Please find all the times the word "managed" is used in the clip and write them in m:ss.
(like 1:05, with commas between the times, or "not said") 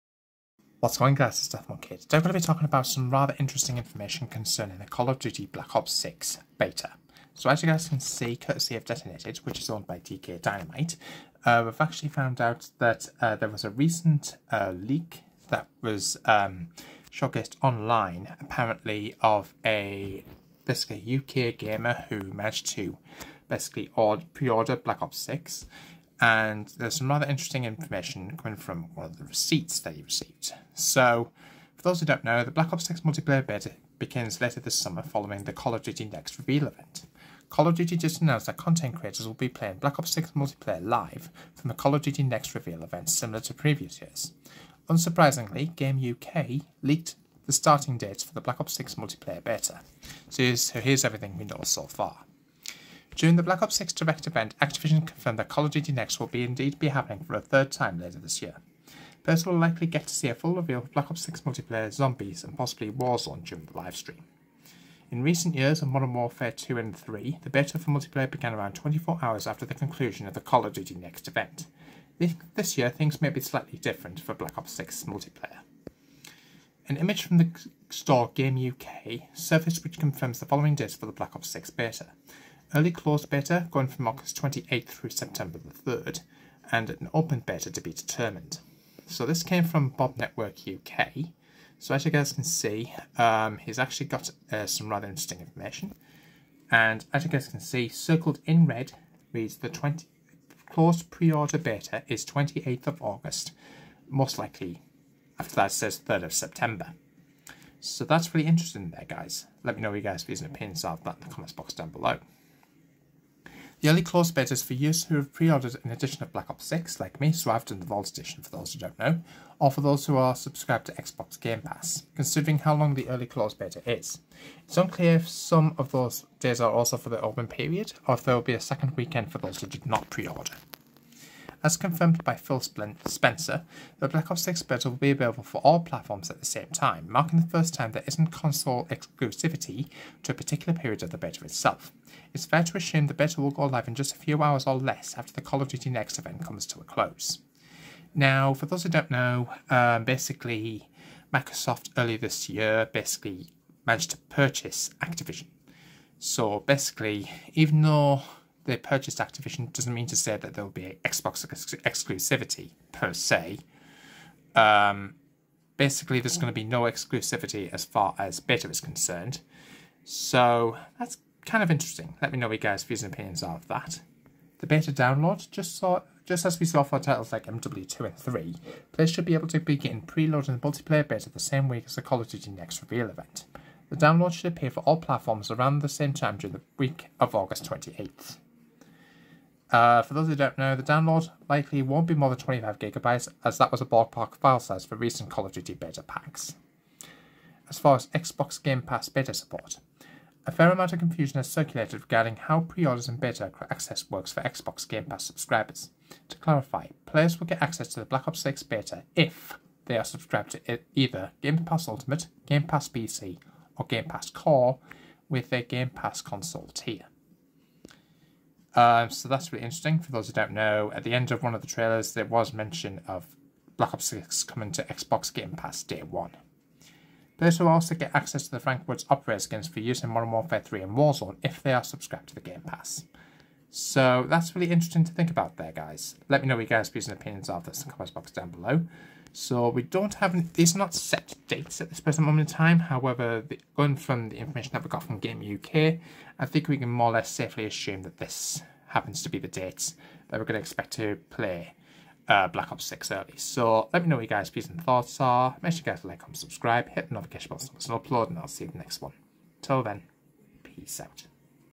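0:22, 2:33.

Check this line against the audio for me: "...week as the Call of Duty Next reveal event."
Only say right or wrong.
right.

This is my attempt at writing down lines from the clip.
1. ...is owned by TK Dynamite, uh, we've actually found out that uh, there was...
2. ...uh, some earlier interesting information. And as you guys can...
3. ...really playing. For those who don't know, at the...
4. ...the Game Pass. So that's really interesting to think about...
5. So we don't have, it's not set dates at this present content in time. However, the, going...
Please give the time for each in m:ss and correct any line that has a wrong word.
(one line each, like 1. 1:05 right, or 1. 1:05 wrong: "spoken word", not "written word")
1. 0:09 right
2. 1:34 wrong: "rather", not "earlier"
3. 3:39 wrong: "interesting", not "playing"
4. 3:52 right
5. 3:59 wrong: "moment", not "content".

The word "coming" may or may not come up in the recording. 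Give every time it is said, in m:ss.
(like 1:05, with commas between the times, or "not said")
0:28, 3:44.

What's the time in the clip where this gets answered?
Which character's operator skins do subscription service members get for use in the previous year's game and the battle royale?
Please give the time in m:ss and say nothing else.
3:48.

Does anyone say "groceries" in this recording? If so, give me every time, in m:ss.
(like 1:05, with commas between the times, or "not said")
not said.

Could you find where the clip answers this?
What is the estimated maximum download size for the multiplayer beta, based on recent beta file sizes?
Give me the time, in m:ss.
3:12.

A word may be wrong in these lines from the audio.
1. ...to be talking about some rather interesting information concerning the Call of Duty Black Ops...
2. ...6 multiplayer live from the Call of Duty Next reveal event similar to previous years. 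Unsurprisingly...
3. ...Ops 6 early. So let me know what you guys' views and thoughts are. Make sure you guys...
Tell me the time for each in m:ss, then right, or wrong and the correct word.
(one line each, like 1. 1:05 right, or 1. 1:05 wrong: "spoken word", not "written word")
1. 0:02 right
2. 0:40 right
3. 4:12 right.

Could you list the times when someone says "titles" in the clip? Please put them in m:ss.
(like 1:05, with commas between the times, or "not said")
2:56.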